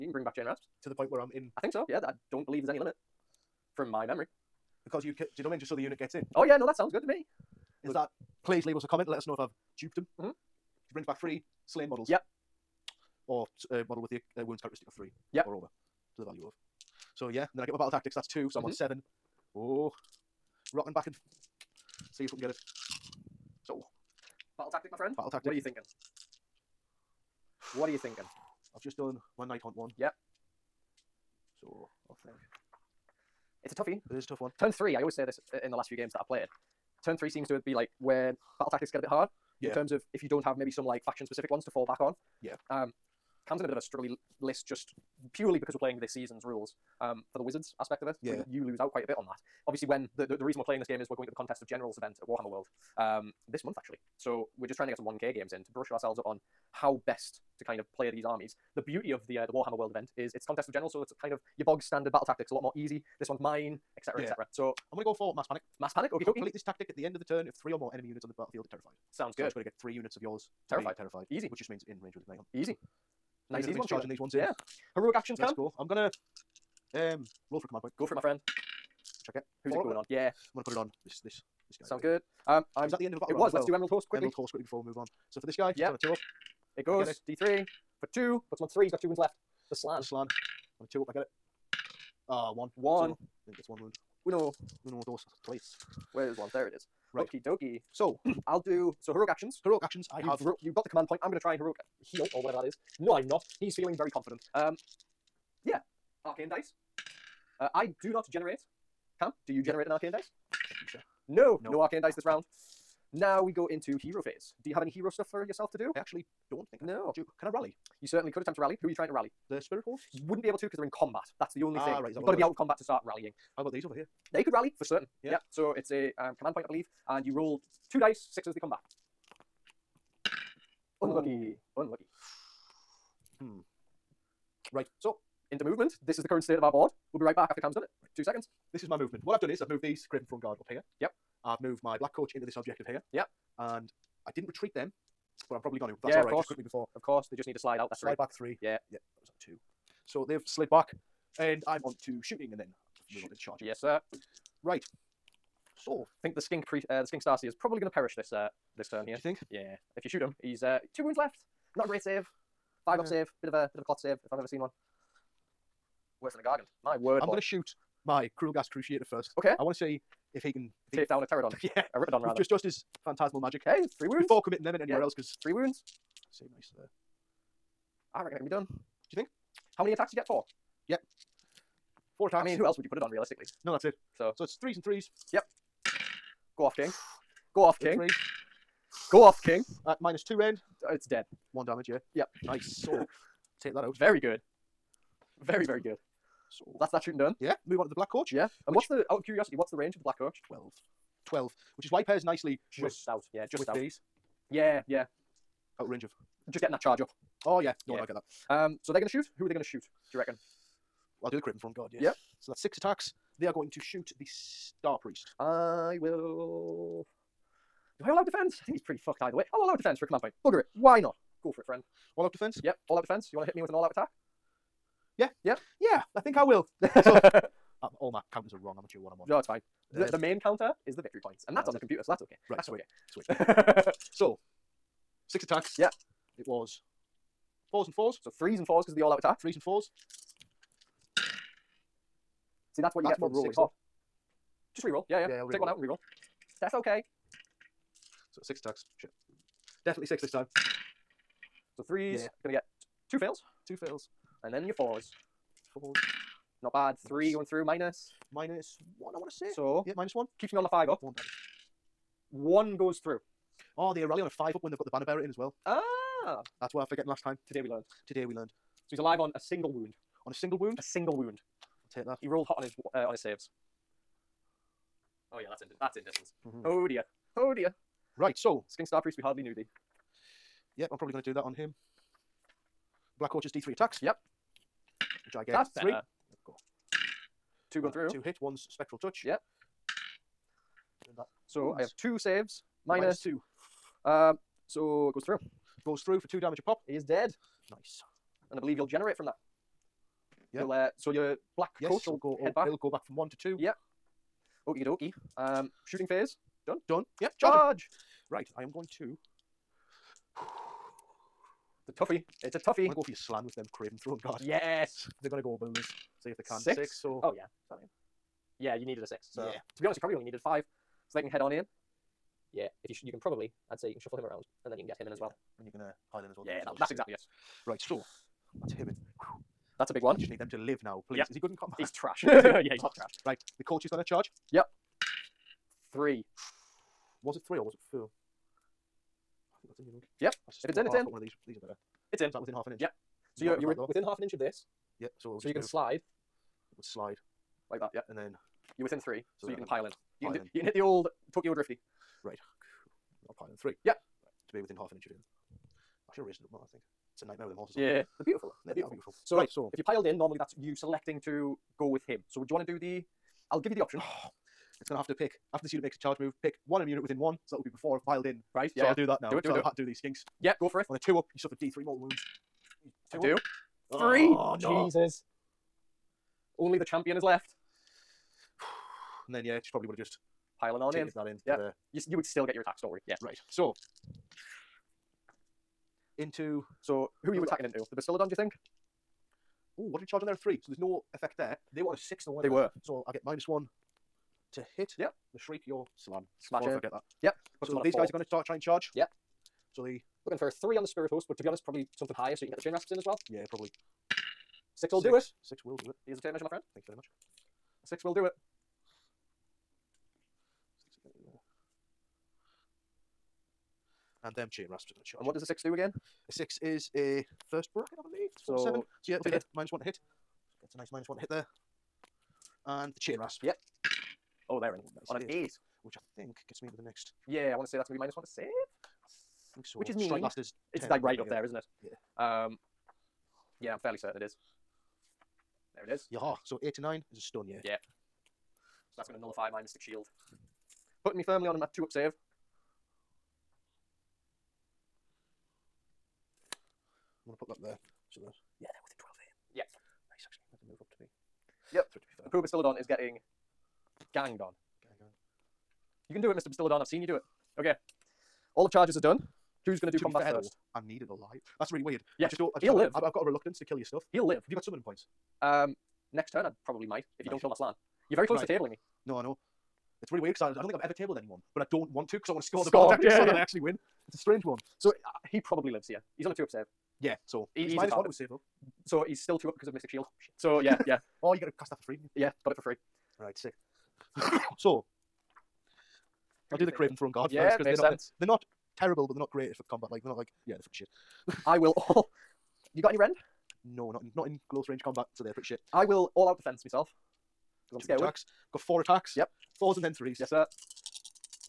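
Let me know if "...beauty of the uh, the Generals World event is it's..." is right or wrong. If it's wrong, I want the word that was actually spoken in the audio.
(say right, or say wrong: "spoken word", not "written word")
wrong: "Warhammer", not "Generals".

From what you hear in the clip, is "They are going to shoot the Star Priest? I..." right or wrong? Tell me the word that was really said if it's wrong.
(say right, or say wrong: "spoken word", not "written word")
right.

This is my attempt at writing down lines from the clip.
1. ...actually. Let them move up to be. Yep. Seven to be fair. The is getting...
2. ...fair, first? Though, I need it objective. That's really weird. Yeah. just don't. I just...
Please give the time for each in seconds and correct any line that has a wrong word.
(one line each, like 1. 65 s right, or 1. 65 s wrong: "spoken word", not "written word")
1. 450 s wrong: "Three", not "Seven"
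2. 460 s wrong: "alive", not "objective".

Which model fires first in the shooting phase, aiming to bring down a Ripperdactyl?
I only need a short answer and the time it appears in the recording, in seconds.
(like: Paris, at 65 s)
Krulghast Cruciator, at 168 s.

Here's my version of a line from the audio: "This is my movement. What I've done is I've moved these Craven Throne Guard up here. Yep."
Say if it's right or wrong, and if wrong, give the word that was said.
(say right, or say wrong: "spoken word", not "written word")
right.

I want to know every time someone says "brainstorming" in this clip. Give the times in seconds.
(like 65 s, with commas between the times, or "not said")
not said.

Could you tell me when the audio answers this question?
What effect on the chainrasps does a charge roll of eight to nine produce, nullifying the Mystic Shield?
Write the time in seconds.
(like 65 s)
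437 s.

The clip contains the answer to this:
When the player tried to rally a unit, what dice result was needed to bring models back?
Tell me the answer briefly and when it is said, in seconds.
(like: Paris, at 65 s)
sixes, at 128 s.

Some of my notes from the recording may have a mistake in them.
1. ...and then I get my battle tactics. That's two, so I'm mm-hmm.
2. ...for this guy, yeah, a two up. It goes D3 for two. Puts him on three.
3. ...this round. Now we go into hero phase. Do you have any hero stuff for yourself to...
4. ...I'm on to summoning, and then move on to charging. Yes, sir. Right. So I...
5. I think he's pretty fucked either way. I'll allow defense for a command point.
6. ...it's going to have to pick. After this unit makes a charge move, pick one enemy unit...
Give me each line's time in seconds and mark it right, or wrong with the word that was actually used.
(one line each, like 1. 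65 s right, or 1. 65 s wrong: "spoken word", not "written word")
1. 17 s right
2. 85 s right
3. 112 s right
4. 151 s wrong: "shooting", not "summoning"
5. 218 s right
6. 364 s right.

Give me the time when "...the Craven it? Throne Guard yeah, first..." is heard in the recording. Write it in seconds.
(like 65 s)
486 s.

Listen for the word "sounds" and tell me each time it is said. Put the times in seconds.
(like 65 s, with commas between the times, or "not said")
6 s, 69 s, 81 s.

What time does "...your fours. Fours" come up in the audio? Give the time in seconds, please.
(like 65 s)
254 s.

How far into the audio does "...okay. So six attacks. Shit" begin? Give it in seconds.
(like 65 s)
246 s.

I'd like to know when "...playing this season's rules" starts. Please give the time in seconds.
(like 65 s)
45 s.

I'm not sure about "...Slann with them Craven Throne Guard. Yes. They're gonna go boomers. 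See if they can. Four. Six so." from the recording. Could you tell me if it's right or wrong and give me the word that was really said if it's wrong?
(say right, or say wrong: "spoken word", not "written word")
wrong: "Six", not "Four".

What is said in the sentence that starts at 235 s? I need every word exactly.
Yeah, it was fours and fours.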